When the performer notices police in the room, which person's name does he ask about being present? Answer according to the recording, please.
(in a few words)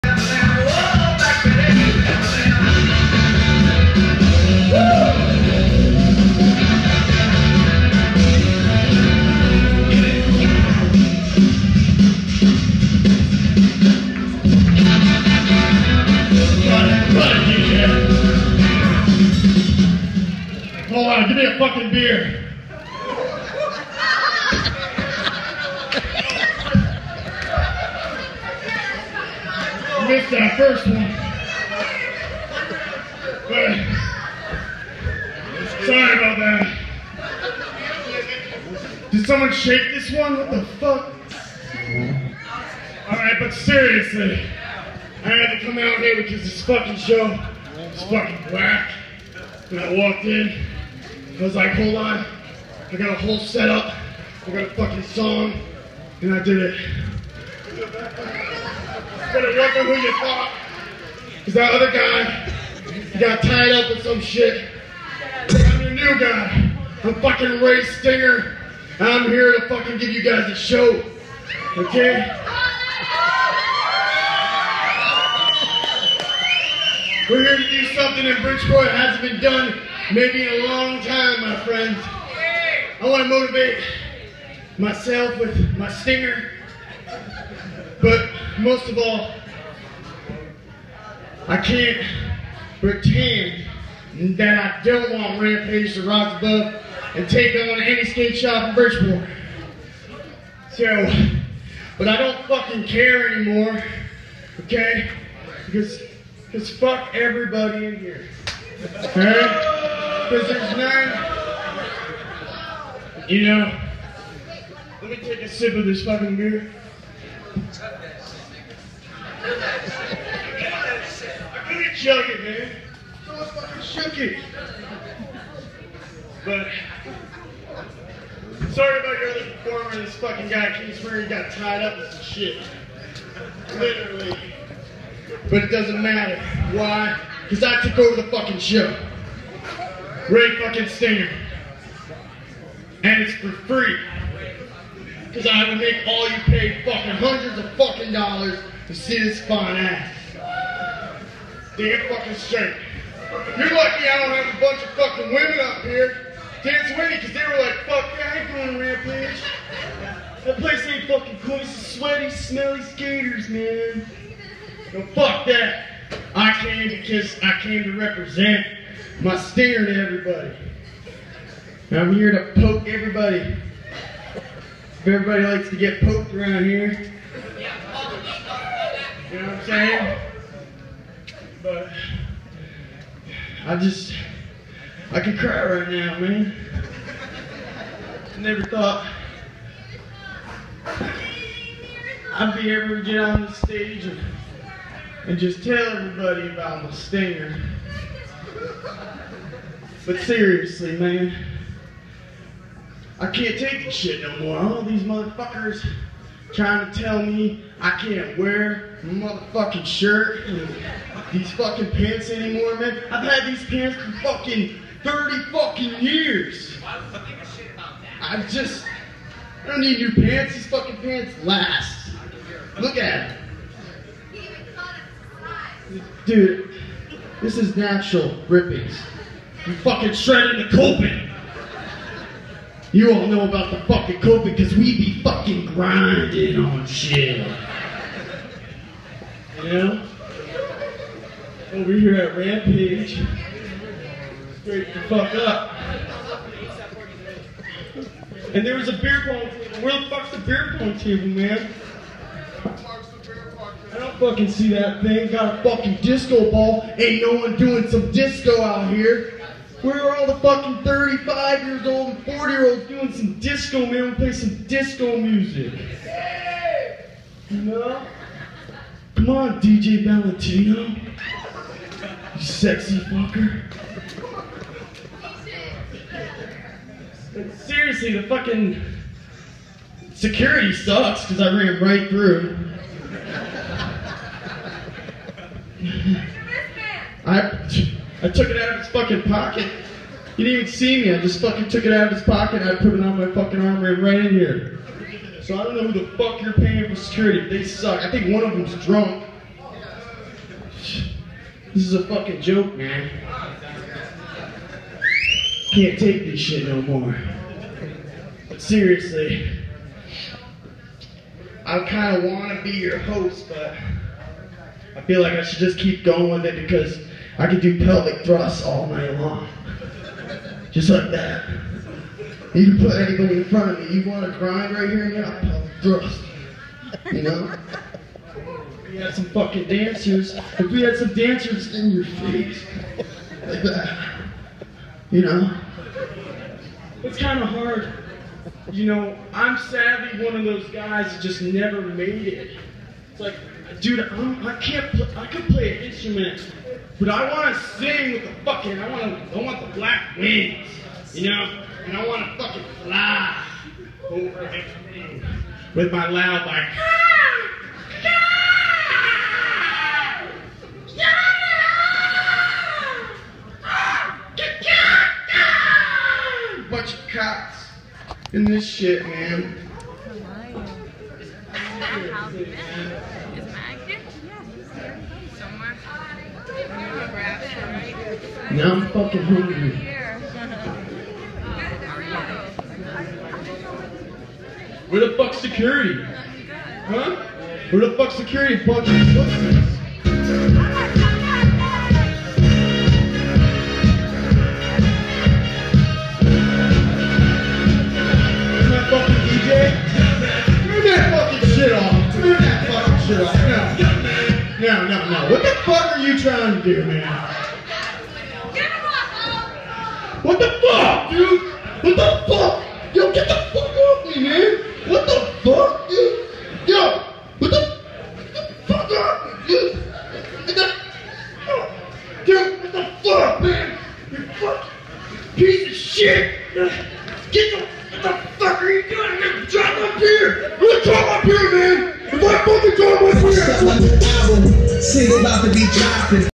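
Matt.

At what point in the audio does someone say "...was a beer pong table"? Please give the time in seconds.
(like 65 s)
248 s.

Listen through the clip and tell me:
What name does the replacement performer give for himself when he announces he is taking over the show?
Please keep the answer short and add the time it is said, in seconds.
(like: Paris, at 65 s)
Ray Stinger, at 67 s.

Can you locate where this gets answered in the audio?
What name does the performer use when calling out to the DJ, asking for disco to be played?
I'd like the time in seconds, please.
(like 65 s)
269 s.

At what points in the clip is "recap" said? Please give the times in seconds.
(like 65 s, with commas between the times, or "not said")
not said.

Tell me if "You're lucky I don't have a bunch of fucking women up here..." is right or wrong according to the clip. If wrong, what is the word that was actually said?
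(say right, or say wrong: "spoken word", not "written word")
right.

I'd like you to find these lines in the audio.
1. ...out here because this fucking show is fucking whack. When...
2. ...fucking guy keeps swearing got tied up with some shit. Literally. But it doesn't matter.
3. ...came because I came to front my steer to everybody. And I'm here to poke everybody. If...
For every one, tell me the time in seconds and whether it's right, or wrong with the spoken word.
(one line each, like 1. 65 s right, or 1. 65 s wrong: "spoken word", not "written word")
1. 45 s right
2. 130 s right
3. 166 s wrong: "represent", not "front".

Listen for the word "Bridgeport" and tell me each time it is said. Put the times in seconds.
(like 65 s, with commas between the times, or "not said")
78 s, 98 s.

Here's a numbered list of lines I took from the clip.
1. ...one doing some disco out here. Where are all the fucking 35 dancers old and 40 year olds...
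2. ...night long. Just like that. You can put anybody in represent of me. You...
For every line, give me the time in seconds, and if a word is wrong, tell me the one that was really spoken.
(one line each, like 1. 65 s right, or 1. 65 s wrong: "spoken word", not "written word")
1. 257 s wrong: "years", not "dancers"
2. 318 s wrong: "front", not "represent".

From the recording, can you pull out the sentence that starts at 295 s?
So I don't know who the fuck you're paying for security.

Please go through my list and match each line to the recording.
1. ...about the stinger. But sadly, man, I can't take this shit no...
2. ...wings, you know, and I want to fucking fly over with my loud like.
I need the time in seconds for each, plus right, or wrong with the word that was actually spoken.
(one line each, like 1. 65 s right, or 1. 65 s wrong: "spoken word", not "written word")
1. 196 s wrong: "seriously", not "sadly"
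2. 350 s right.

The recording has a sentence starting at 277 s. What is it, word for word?
seriously, the fucking security sucks because I ran right through.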